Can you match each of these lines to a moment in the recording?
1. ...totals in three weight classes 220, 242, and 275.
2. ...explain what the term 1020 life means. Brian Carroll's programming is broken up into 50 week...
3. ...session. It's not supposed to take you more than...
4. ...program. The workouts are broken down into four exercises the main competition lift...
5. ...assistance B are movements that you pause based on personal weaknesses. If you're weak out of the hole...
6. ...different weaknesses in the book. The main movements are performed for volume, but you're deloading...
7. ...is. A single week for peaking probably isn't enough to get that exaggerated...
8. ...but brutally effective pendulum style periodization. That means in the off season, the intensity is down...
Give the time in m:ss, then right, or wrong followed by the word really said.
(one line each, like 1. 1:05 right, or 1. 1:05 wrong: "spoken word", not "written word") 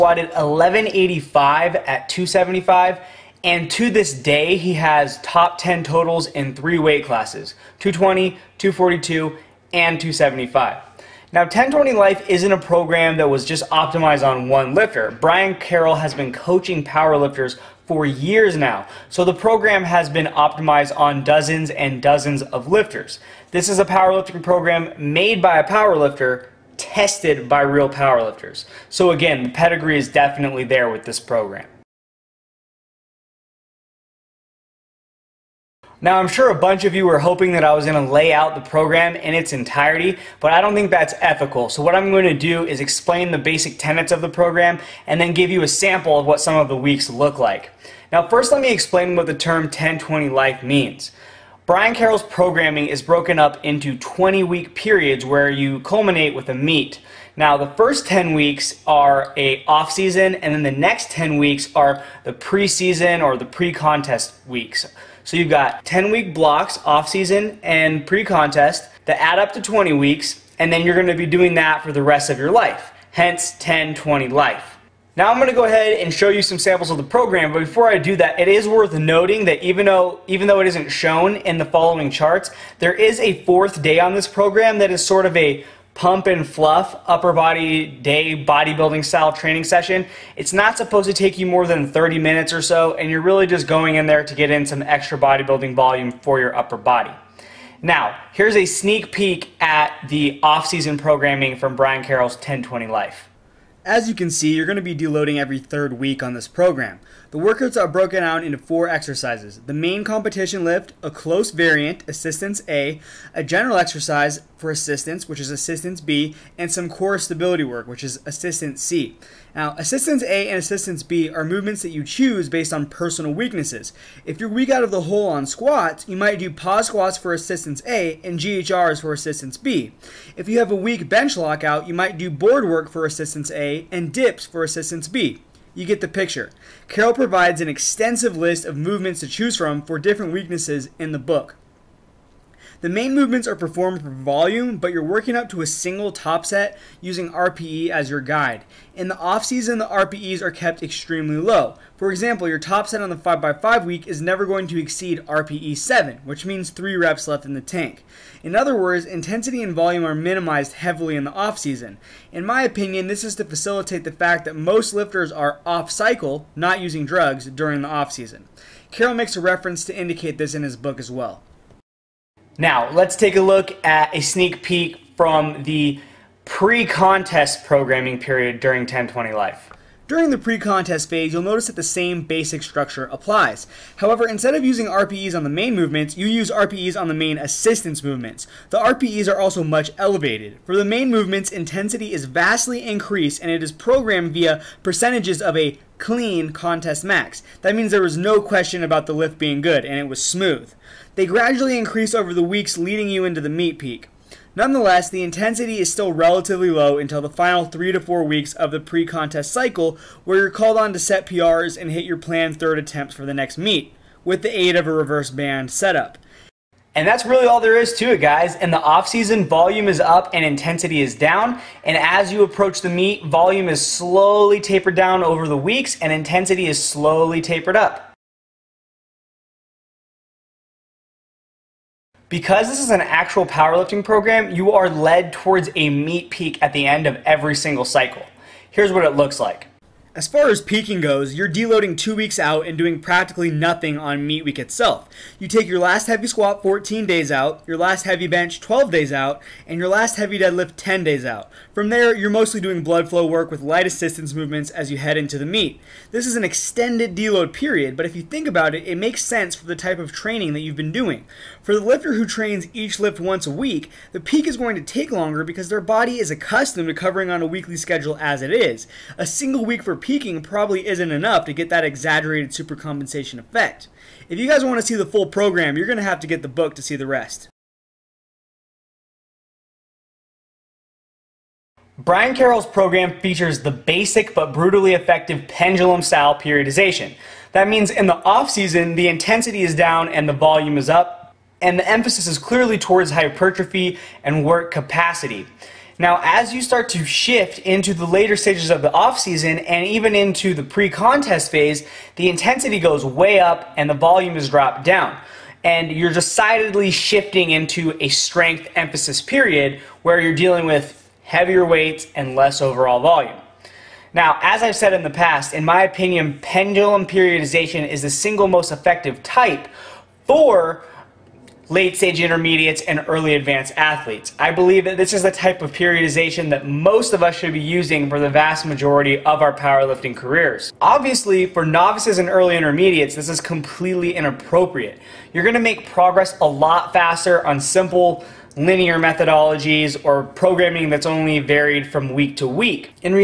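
1. 0:05 right
2. 0:48 wrong: "20", not "50"
3. 1:29 right
4. 1:46 right
5. 2:00 wrong: "choose", not "pause"
6. 2:19 wrong: "working", not "deloading"
7. 4:28 right
8. 4:44 right.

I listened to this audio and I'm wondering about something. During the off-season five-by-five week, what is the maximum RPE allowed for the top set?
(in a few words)
7.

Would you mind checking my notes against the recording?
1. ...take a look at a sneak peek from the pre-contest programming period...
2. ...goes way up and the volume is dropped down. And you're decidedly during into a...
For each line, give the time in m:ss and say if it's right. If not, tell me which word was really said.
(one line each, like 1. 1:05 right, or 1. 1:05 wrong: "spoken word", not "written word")
1. 2:53 right
2. 5:02 wrong: "shifting", not "during".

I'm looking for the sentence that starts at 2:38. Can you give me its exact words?
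In other words, intensity and volume are minimized heavily in the off season.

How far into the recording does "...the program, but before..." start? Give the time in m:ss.
1:16.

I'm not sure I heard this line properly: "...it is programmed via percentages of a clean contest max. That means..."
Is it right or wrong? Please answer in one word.
right.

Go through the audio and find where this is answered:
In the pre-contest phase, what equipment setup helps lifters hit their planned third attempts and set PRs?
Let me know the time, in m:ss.
3:34.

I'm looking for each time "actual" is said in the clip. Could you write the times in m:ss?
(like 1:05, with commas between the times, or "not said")
3:53.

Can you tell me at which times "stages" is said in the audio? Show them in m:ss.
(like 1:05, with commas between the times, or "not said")
4:58, 5:21.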